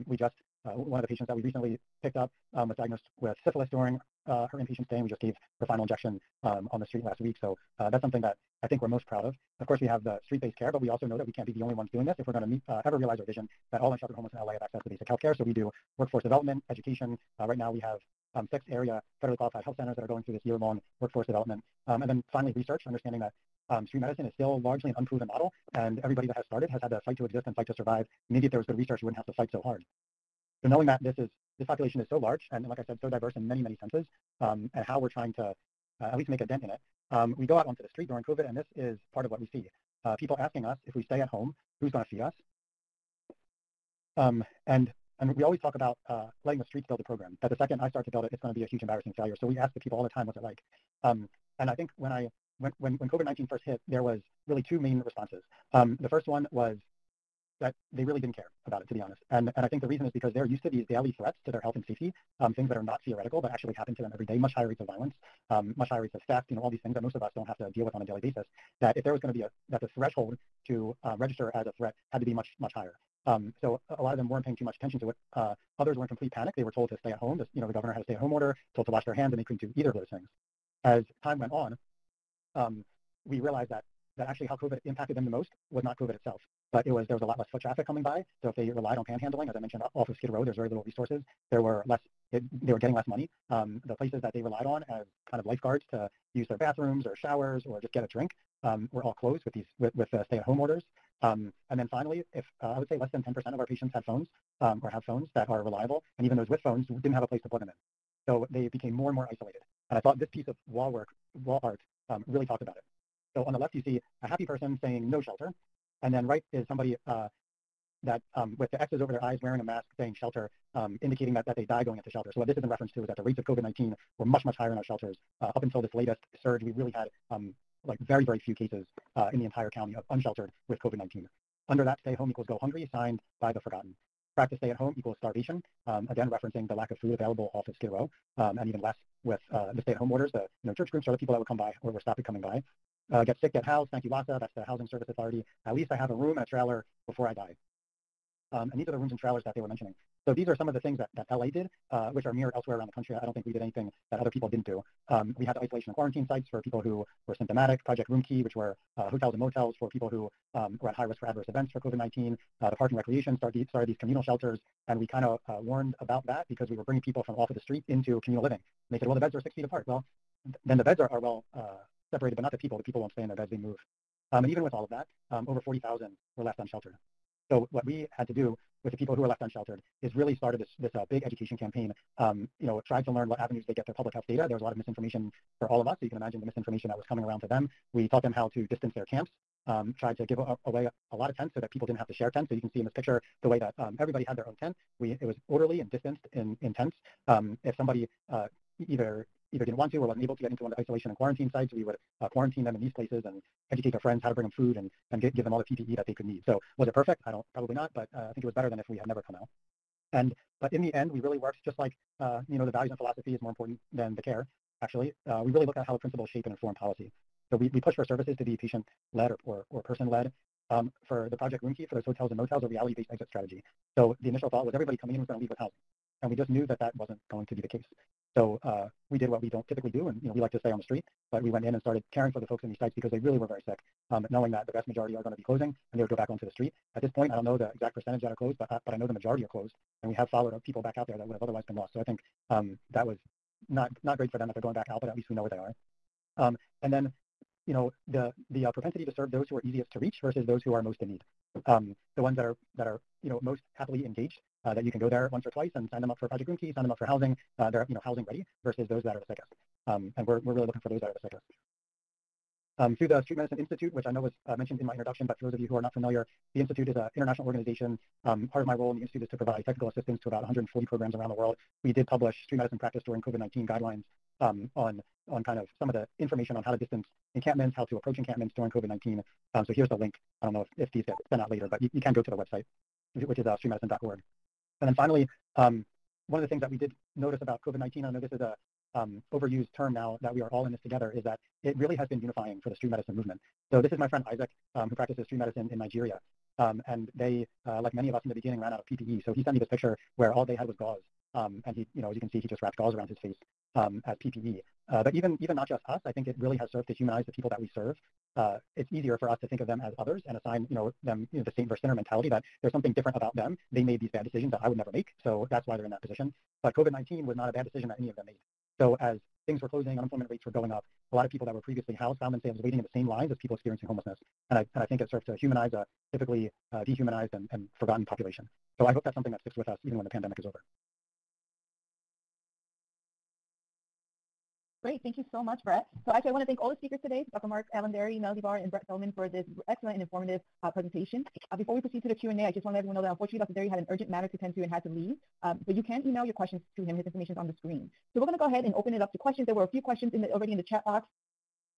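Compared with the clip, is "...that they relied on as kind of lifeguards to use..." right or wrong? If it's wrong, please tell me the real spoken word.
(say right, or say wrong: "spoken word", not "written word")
right.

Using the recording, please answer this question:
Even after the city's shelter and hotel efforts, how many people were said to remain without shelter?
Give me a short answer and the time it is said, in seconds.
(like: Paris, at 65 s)
over 40,000, at 175 s.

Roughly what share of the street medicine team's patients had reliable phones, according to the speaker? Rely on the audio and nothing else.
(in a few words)
less than 10%.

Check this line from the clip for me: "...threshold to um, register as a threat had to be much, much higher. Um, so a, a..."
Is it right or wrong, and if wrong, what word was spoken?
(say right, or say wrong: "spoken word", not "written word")
right.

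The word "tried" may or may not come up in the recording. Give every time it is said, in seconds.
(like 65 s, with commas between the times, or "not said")
182 s, 190 s.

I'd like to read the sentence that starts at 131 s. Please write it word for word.
Under that, stay home equals go hungry, signed by the forgotten.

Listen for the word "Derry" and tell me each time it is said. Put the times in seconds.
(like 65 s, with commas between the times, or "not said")
337 s, 343 s.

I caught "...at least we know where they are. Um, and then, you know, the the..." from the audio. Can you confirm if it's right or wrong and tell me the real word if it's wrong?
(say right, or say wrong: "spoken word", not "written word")
right.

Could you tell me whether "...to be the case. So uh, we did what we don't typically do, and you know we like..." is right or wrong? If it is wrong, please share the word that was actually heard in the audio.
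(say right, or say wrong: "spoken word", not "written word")
right.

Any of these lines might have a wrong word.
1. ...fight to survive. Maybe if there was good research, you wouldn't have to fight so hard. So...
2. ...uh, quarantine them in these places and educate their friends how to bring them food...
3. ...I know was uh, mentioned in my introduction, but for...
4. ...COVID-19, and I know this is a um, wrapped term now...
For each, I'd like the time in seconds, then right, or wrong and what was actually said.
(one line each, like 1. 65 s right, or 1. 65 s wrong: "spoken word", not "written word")
1. 27 s right
2. 202 s right
3. 264 s right
4. 287 s wrong: "overused", not "wrapped".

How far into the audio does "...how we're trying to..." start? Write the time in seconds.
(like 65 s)
34 s.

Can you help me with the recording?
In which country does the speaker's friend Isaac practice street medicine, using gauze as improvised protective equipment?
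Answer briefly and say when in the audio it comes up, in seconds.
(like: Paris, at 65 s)
Nigeria, at 295 s.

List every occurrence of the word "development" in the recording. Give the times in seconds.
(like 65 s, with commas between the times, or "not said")
16 s, 21 s.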